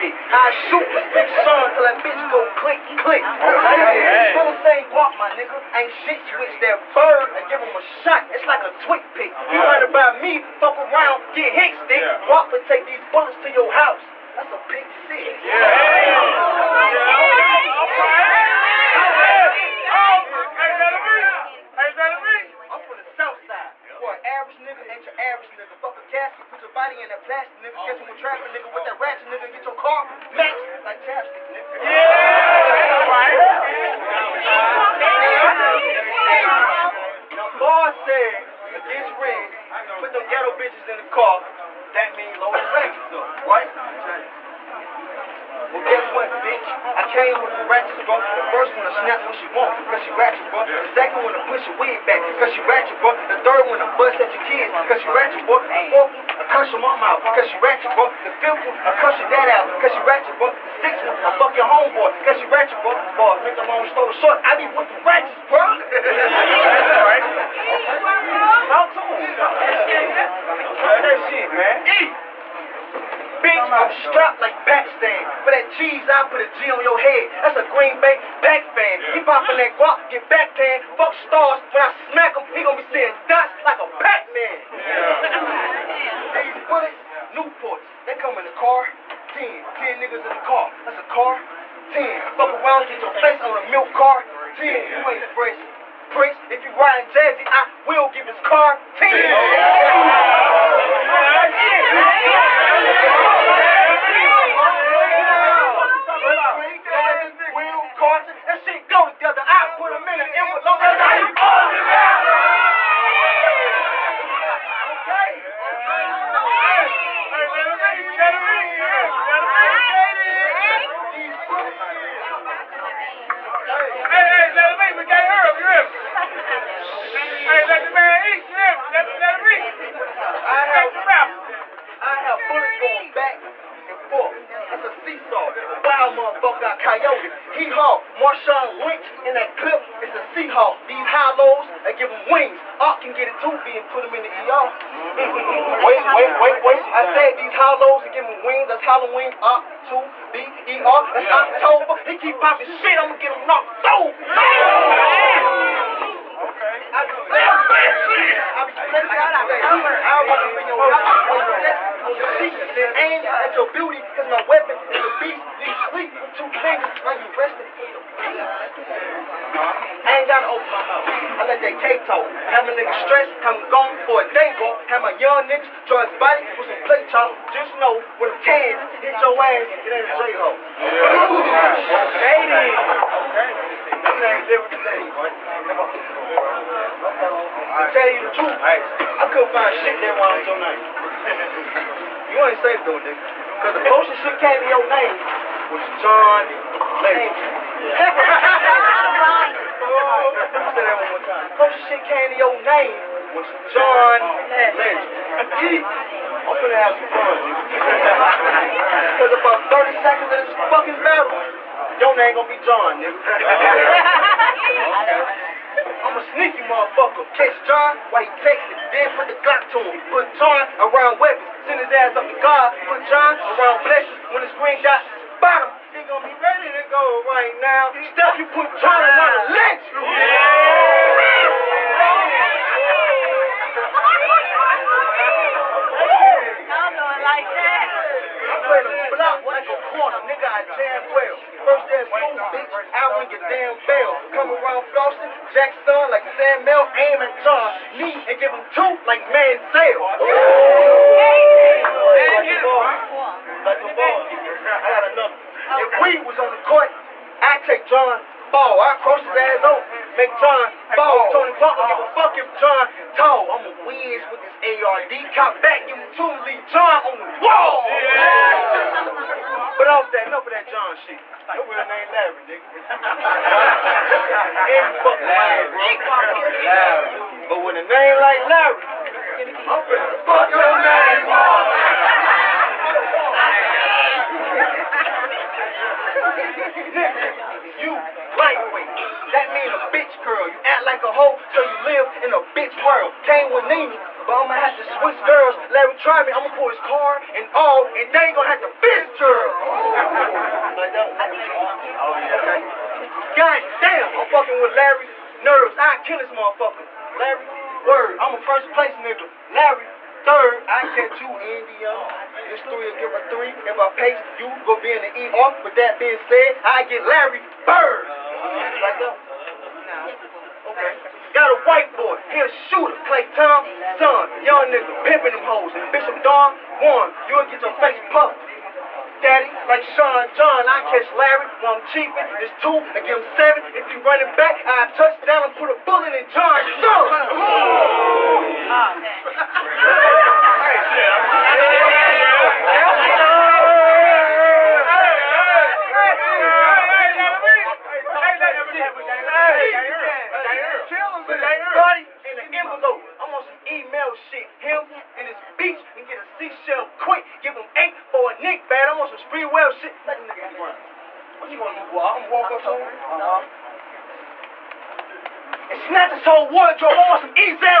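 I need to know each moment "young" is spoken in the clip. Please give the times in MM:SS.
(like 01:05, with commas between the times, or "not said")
02:55, 05:24.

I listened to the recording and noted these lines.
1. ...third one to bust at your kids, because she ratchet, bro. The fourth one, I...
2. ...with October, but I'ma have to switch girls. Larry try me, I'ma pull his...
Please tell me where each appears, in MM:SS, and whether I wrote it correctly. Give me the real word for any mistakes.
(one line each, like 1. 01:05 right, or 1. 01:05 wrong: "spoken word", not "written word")
1. 00:53 right
2. 04:53 wrong: "Nene", not "October".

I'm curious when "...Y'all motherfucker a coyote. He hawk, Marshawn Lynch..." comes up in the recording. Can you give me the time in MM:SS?
02:16.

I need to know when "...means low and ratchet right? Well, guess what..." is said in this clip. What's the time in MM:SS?
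00:42.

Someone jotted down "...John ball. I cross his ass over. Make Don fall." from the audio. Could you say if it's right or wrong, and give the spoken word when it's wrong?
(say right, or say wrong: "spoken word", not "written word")
wrong: "John", not "Don".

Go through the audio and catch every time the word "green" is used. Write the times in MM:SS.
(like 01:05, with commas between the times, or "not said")
01:17, 03:44.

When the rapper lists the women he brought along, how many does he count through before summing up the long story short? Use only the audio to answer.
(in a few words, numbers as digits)
6.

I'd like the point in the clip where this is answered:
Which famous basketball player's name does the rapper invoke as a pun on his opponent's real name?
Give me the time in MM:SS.
05:17.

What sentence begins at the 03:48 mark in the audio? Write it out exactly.
Step, you put Jordan on the lynch.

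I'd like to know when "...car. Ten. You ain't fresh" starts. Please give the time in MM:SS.
01:33.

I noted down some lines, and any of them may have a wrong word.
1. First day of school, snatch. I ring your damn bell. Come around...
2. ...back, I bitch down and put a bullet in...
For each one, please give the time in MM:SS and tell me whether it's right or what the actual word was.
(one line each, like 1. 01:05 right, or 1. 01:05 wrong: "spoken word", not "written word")
1. 04:01 wrong: "bitch", not "snatch"
2. 05:34 wrong: "touch", not "bitch".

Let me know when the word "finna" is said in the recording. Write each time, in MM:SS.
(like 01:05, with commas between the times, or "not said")
03:26, 04:39.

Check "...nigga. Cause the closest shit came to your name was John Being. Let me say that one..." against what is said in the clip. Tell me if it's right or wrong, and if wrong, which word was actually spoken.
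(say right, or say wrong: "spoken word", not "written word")
wrong: "Legend", not "Being".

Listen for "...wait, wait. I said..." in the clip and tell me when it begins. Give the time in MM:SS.
02:26.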